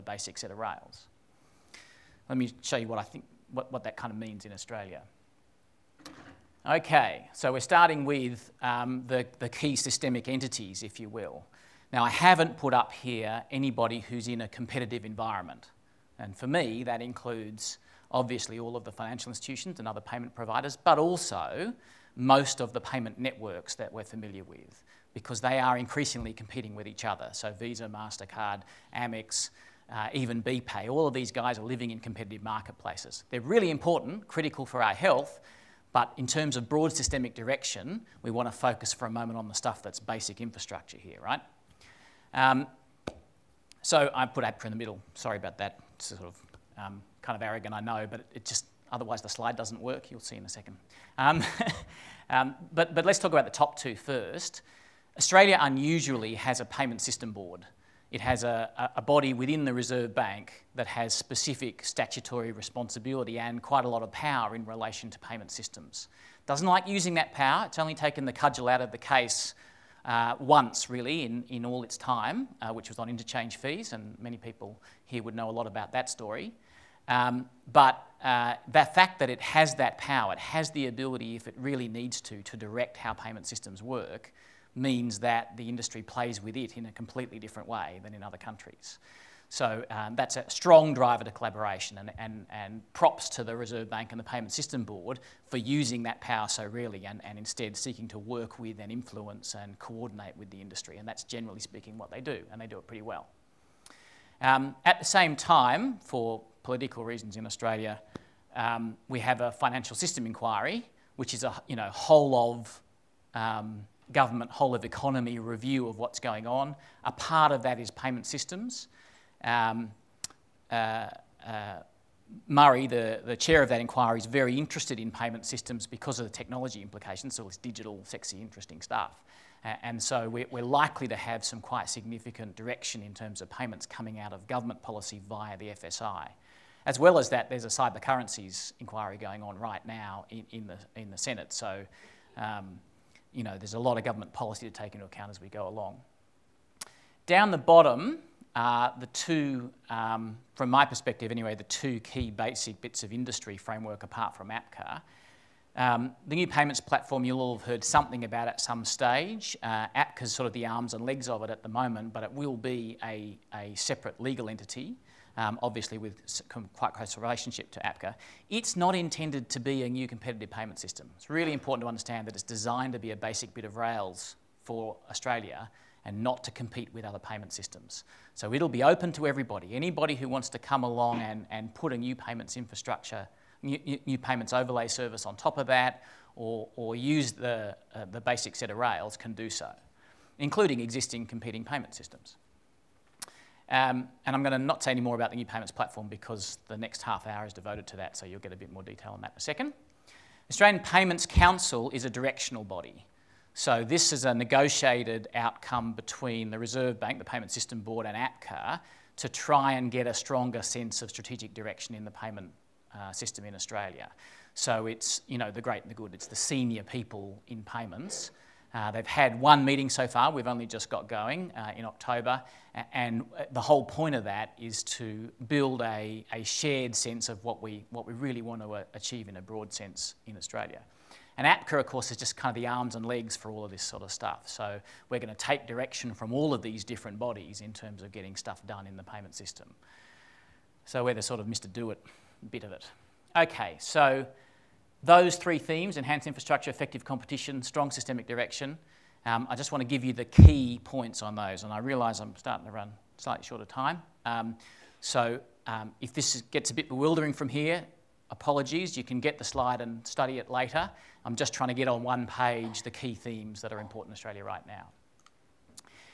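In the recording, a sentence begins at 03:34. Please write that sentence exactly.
So it's, you know, the great and the good.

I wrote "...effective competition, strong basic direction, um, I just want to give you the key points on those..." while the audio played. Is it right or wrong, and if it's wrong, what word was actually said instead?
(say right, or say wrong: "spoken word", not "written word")
wrong: "systemic", not "basic".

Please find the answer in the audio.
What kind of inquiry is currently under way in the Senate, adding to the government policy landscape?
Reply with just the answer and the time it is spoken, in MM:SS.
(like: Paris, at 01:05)
Cyber currencies inquiry, at 02:17.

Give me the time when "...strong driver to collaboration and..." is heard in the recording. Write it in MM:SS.
01:30.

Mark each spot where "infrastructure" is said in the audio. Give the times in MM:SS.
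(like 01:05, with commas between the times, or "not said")
00:40, 03:02, 04:06.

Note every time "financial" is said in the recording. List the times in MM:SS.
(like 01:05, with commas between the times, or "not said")
00:18, 01:49.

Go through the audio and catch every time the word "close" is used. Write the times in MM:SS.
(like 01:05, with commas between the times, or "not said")
02:46.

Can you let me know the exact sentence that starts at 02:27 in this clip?
Down the bottom are the two, um, from my perspective anyway, the two key basic bits of industry framework apart from APCA.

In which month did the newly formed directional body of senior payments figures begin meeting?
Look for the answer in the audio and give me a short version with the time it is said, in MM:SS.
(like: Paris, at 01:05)
October, at 03:41.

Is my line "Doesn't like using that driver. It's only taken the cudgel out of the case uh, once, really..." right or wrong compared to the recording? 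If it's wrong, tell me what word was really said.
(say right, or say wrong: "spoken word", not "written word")
wrong: "power", not "driver".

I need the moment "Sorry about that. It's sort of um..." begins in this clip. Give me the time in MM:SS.
00:45.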